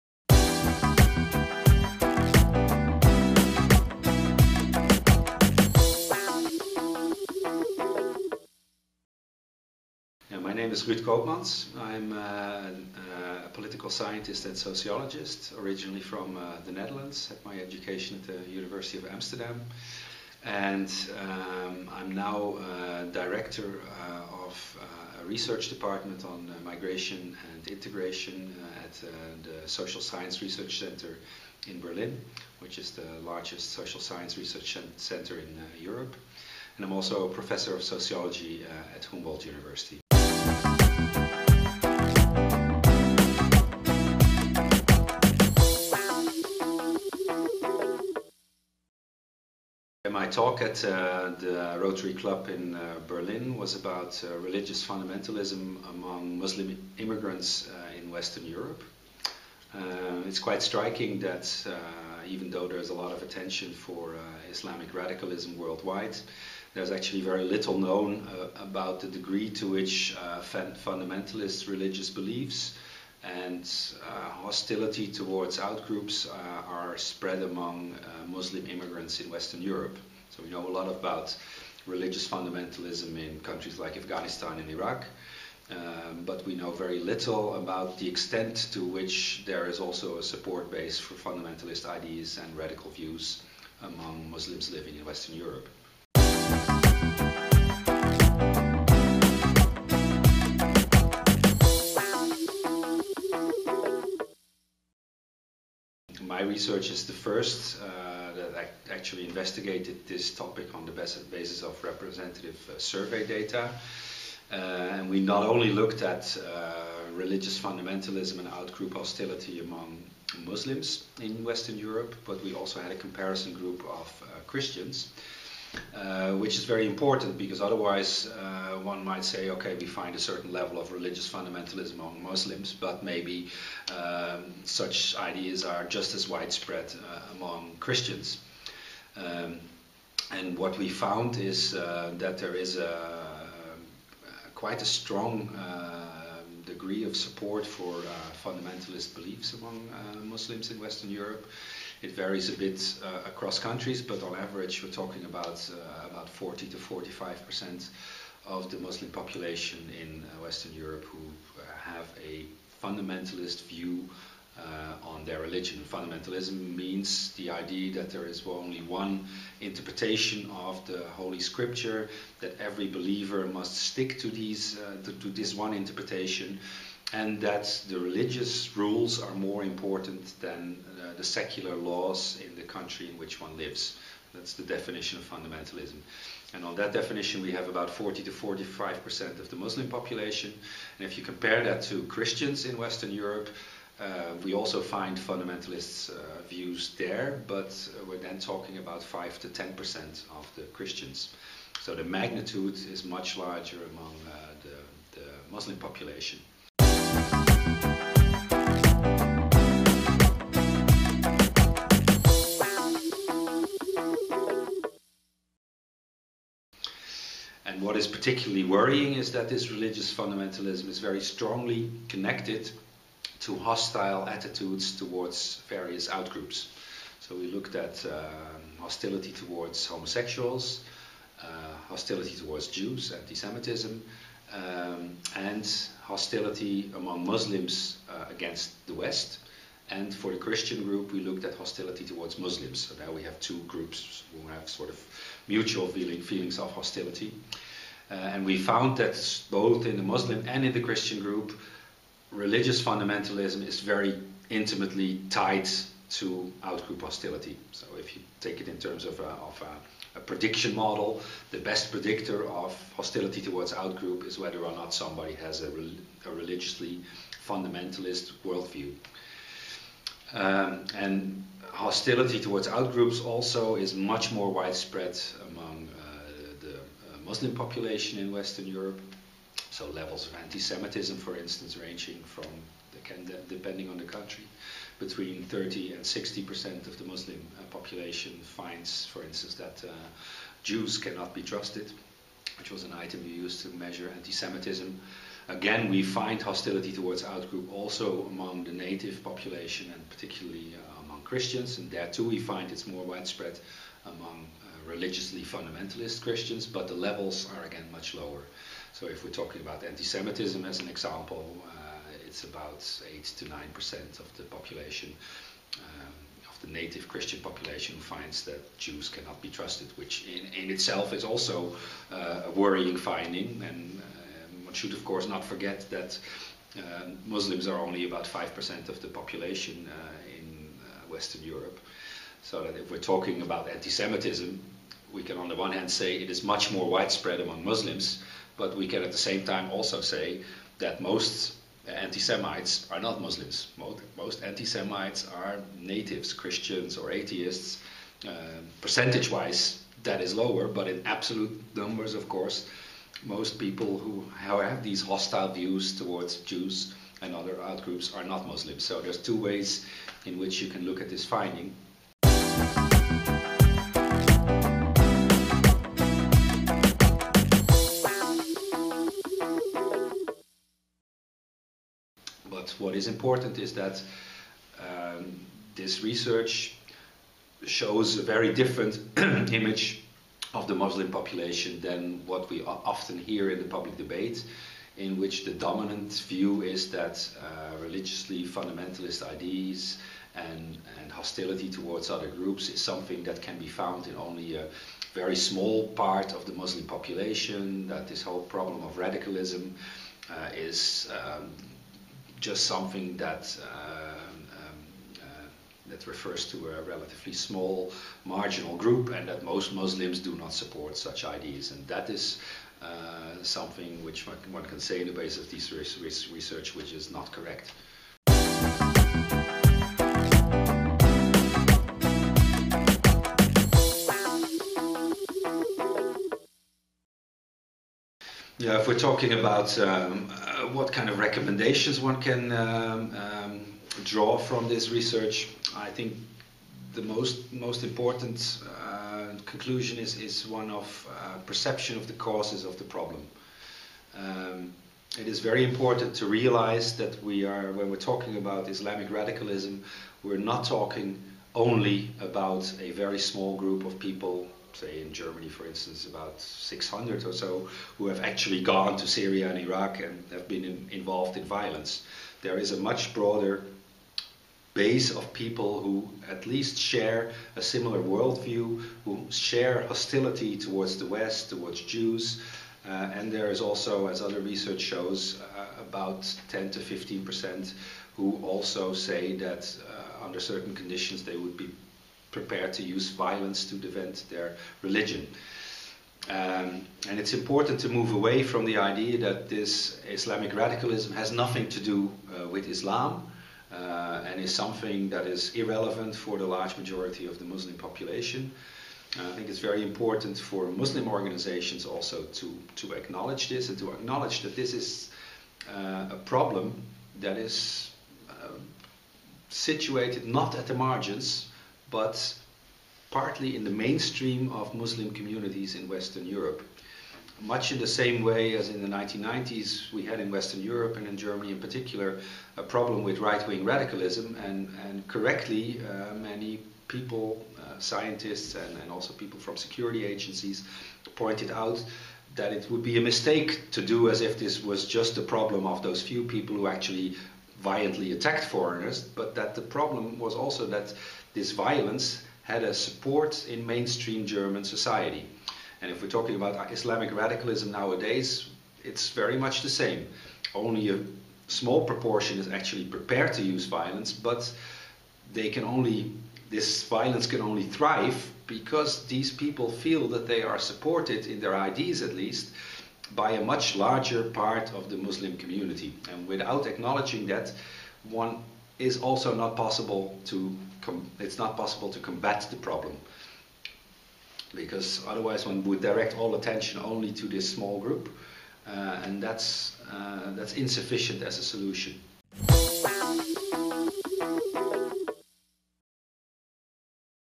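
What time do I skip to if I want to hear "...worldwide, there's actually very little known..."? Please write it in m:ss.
1:05.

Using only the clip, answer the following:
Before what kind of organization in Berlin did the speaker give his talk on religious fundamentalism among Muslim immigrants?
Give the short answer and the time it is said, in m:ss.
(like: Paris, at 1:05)
Rotary Club, at 0:51.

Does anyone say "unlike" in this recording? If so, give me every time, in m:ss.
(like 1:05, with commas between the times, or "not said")
not said.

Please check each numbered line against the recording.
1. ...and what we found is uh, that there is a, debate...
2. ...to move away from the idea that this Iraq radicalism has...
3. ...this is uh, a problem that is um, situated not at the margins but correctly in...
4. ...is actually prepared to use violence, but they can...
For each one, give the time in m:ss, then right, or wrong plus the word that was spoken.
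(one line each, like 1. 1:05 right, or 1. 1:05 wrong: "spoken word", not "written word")
1. 2:20 wrong: "quite", not "debate"
2. 8:07 wrong: "Islamic", not "Iraq"
3. 8:24 wrong: "partly", not "correctly"
4. 9:12 right.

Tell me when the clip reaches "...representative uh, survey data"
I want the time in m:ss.
1:51.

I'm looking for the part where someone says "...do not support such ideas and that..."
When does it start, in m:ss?
6:50.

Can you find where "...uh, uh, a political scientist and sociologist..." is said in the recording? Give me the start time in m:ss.
0:12.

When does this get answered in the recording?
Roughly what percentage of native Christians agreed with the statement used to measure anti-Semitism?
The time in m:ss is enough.
5:13.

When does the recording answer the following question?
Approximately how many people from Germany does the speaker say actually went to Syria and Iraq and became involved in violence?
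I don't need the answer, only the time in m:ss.
7:36.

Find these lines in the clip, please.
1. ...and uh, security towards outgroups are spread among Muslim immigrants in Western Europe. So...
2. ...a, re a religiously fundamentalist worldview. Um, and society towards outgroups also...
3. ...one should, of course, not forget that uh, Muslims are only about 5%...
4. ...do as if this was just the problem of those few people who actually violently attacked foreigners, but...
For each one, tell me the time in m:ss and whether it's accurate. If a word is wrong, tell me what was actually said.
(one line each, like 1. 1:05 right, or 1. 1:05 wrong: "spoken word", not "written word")
1. 1:13 wrong: "hostility", not "security"
2. 4:25 wrong: "hostility", not "society"
3. 5:24 right
4. 8:53 right.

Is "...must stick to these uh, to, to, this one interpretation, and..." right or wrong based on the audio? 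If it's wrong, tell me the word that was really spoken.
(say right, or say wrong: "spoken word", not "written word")
right.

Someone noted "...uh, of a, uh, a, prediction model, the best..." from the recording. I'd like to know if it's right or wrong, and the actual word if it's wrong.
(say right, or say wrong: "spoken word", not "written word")
right.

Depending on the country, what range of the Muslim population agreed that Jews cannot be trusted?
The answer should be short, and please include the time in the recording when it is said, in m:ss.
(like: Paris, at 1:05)
30 to 60 percent, at 4:44.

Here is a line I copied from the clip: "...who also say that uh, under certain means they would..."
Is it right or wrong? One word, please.
wrong.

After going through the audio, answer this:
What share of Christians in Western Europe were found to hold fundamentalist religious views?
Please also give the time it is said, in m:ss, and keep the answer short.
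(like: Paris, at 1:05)
5 to 10 percent, at 3:19.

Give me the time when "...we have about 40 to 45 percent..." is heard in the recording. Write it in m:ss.
3:07.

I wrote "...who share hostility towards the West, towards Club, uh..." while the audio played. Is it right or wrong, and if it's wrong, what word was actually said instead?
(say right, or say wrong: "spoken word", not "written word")
wrong: "Jews", not "Club".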